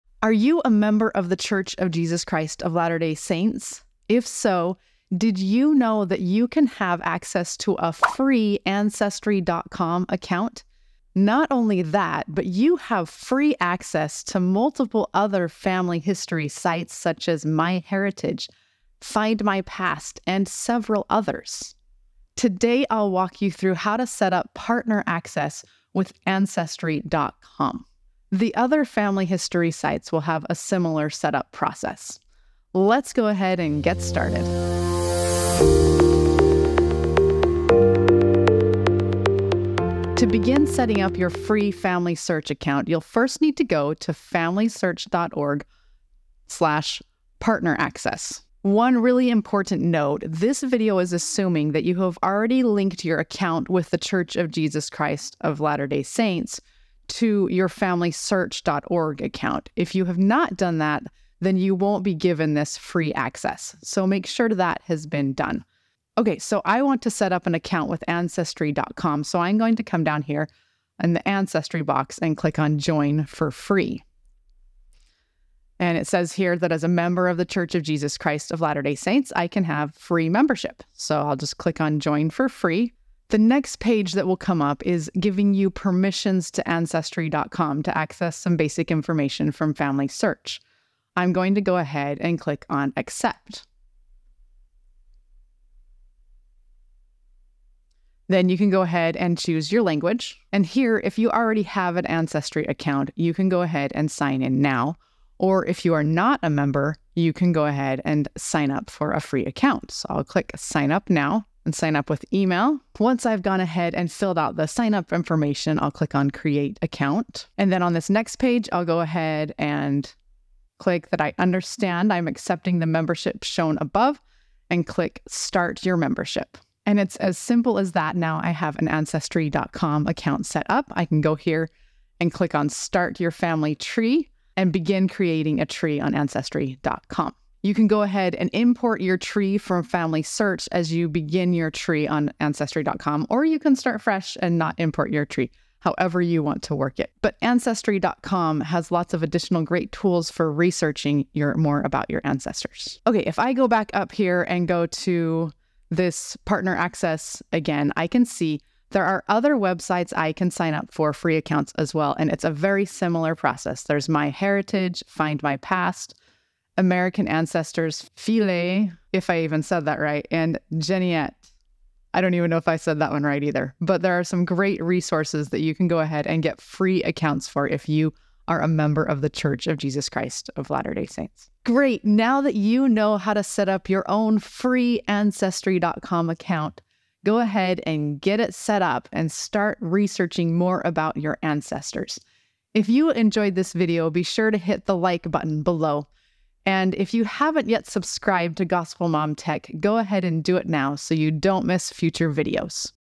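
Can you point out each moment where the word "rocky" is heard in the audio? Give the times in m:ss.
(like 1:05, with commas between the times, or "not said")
not said.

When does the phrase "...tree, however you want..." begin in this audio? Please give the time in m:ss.
2:25.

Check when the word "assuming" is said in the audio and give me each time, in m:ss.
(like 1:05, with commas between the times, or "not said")
0:51.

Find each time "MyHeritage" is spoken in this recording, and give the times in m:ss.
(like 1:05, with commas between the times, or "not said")
0:17.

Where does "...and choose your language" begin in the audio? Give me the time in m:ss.
1:39.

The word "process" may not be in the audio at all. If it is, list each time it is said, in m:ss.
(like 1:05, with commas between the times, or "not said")
0:31, 2:43.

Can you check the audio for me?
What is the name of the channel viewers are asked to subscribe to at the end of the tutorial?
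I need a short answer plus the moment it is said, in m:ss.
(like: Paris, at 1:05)
Gospel Mom Tech, at 3:18.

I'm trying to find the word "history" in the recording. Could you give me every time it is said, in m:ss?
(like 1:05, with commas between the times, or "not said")
0:15, 0:29.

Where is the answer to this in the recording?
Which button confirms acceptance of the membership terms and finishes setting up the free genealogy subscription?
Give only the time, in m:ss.
2:05.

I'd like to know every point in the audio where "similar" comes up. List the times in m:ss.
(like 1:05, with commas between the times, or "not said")
0:30, 2:42.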